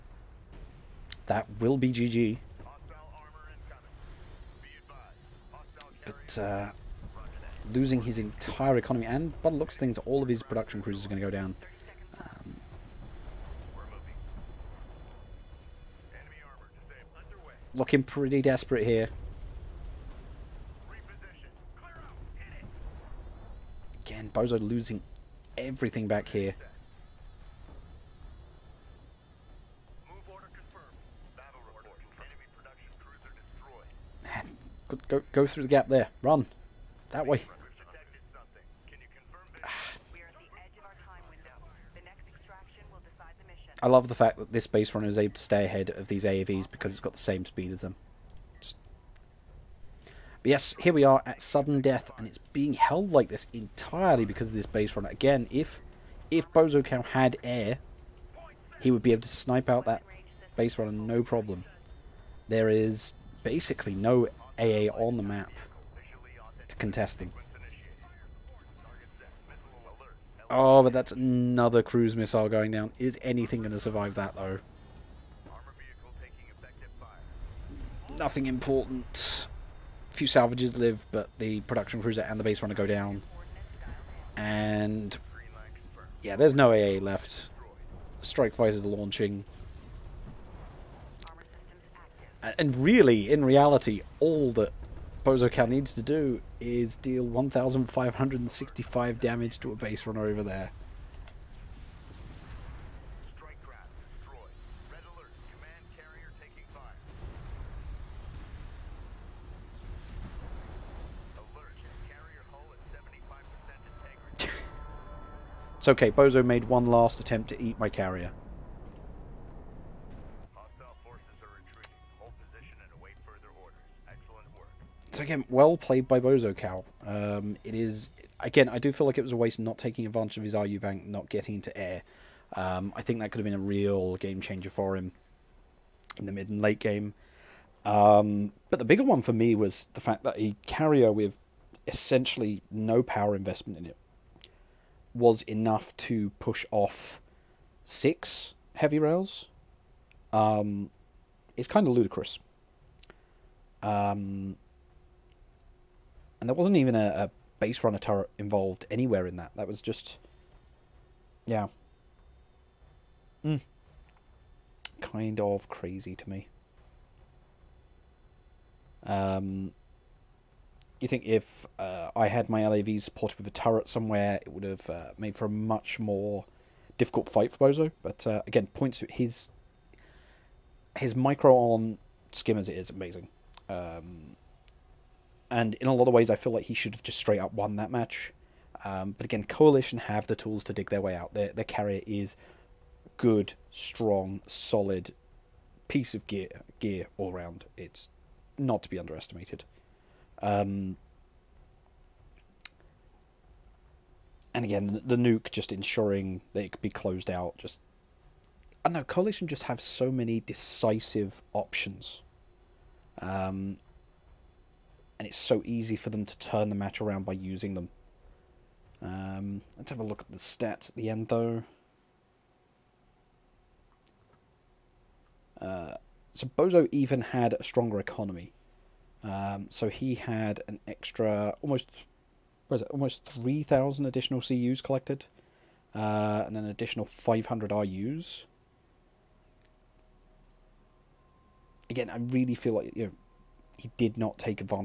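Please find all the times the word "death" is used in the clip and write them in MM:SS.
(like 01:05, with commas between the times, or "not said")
00:51.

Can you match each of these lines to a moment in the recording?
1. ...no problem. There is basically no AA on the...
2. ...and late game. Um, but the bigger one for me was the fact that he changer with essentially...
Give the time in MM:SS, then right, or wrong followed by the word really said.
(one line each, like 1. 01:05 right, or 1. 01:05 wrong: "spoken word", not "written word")
1. 01:00 right
2. 02:16 wrong: "carrier", not "changer".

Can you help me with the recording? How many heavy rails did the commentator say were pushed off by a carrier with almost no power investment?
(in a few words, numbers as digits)
6.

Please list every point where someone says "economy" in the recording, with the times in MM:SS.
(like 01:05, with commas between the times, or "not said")
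00:08, 03:47.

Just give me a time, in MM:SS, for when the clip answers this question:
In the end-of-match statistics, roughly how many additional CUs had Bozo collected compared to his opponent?
03:53.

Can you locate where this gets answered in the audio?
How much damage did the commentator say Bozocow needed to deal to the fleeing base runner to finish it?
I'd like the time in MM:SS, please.
01:37.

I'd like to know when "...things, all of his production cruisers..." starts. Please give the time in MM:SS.
00:09.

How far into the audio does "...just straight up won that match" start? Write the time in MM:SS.
03:07.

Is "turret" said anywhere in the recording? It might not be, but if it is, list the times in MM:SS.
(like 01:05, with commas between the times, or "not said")
02:37, 02:53.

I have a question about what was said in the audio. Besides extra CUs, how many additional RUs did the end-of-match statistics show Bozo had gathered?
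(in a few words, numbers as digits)
500.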